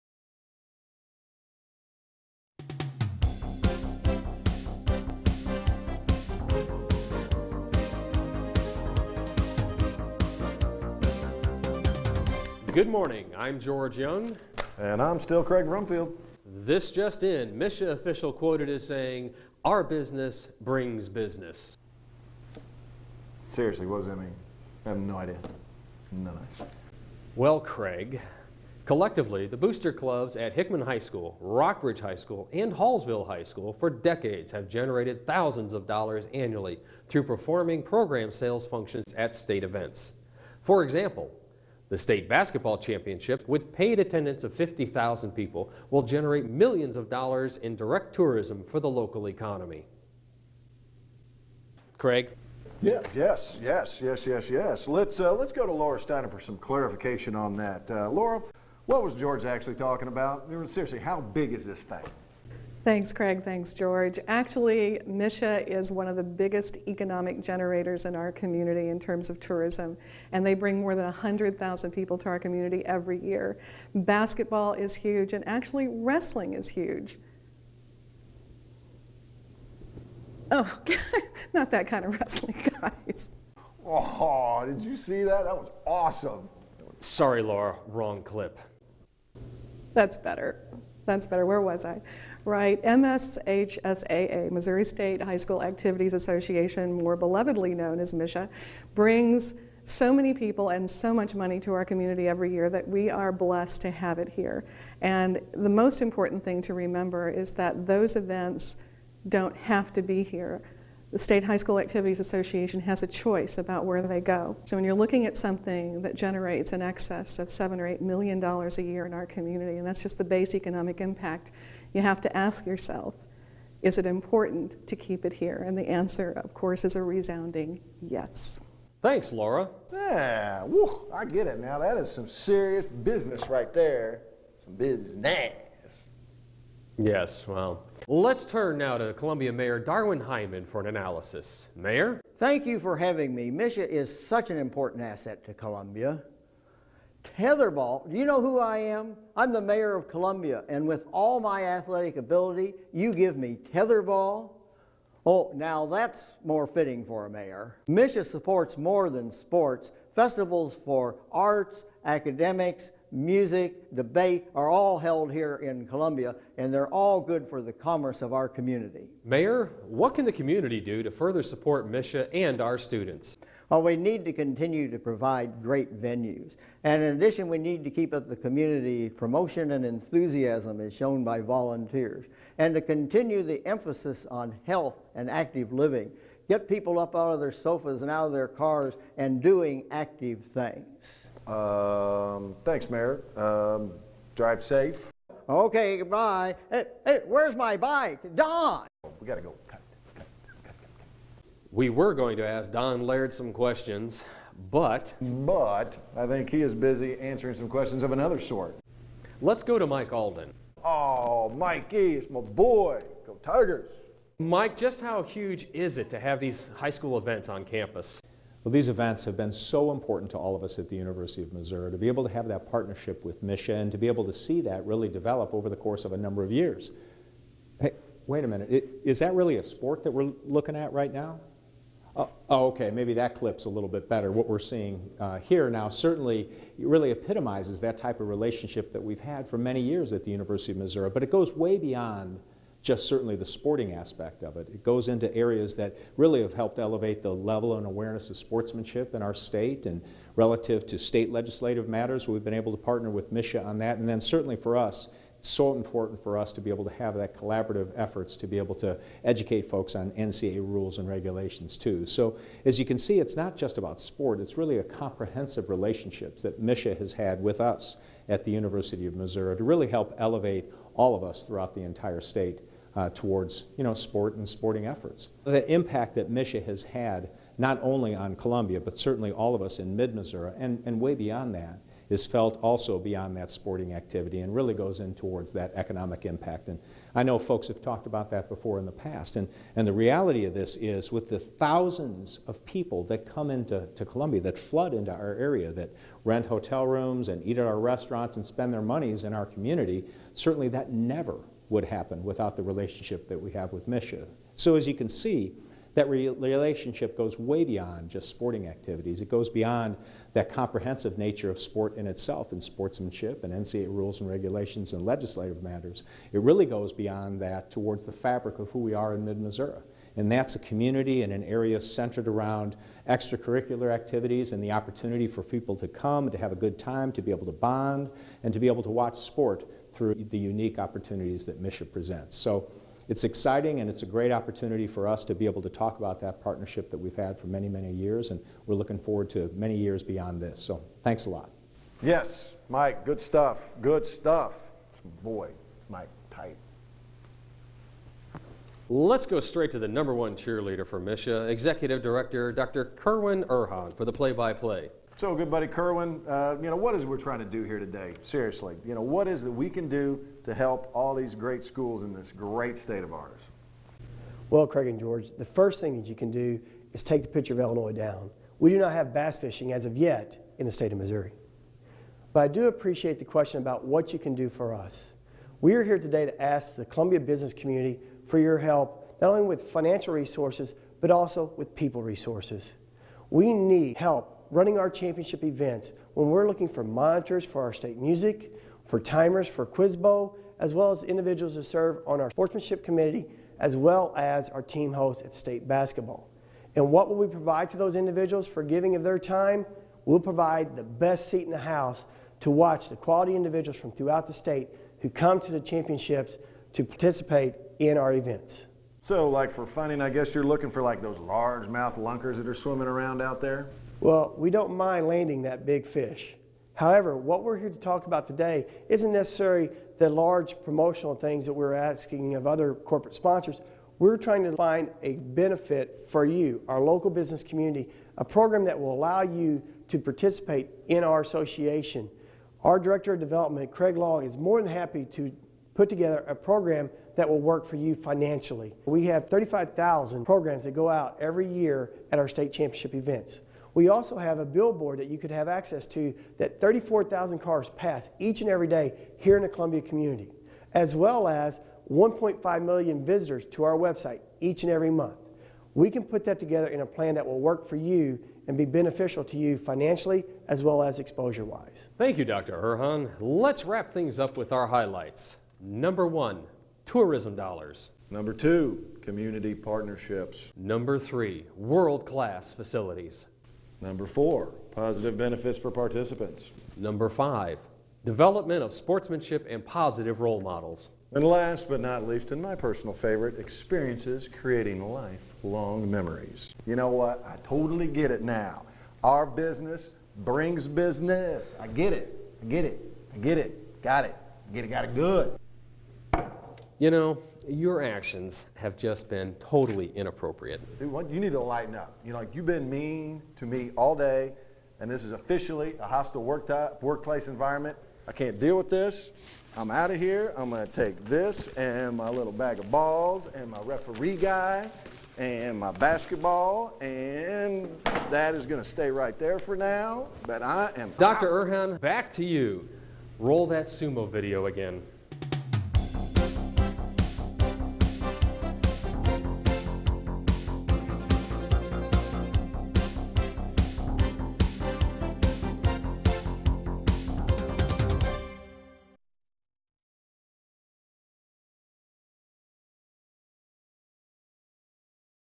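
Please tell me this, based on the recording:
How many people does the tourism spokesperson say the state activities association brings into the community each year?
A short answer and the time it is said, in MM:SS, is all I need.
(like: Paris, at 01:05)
more than 100,000, at 01:10.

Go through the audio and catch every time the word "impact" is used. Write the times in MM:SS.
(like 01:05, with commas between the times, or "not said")
02:01, 04:35, 04:46.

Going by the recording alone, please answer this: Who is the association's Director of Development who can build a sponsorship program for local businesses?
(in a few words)
Craig Long.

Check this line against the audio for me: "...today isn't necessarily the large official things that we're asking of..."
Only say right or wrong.
wrong.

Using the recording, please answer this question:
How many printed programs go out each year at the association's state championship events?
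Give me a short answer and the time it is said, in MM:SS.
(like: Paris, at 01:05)
35,000, at 07:19.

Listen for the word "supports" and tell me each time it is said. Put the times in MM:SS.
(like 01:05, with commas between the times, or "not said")
02:38, 02:51.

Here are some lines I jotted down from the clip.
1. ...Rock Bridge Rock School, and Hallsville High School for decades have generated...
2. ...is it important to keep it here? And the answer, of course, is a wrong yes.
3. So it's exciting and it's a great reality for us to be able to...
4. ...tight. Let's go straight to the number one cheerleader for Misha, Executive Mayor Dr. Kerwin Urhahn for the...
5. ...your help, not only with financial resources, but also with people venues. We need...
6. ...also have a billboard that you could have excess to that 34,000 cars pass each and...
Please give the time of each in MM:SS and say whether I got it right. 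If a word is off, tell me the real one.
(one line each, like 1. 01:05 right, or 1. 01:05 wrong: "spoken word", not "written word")
1. 00:31 wrong: "High", not "Rock"
2. 02:03 wrong: "resounding", not "wrong"
3. 05:32 wrong: "opportunity", not "reality"
4. 05:46 wrong: "Director", not "Mayor"
5. 06:18 wrong: "resources", not "venues"
6. 07:23 wrong: "access", not "excess".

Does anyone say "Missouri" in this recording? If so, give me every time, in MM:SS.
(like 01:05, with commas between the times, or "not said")
01:34, 03:41, 04:00, 04:29, 04:39, 05:19, 06:10.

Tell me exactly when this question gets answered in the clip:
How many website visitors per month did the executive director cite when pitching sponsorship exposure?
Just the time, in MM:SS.
07:31.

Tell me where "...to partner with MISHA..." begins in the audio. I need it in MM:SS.
04:12.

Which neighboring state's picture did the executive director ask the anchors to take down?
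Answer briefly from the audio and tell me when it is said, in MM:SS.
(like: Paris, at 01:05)
Illinois, at 06:07.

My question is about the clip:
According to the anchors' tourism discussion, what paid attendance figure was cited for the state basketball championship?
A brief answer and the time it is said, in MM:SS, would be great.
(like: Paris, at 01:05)
50,000, at 00:44.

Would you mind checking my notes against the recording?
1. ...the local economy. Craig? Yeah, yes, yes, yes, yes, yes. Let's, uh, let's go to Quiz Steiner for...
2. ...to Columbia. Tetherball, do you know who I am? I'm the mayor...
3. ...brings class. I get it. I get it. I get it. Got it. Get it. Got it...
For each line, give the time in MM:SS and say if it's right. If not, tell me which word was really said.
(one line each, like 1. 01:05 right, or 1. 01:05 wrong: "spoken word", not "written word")
1. 00:48 wrong: "Lorah", not "Quiz"
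2. 02:25 right
3. 08:10 wrong: "business", not "class".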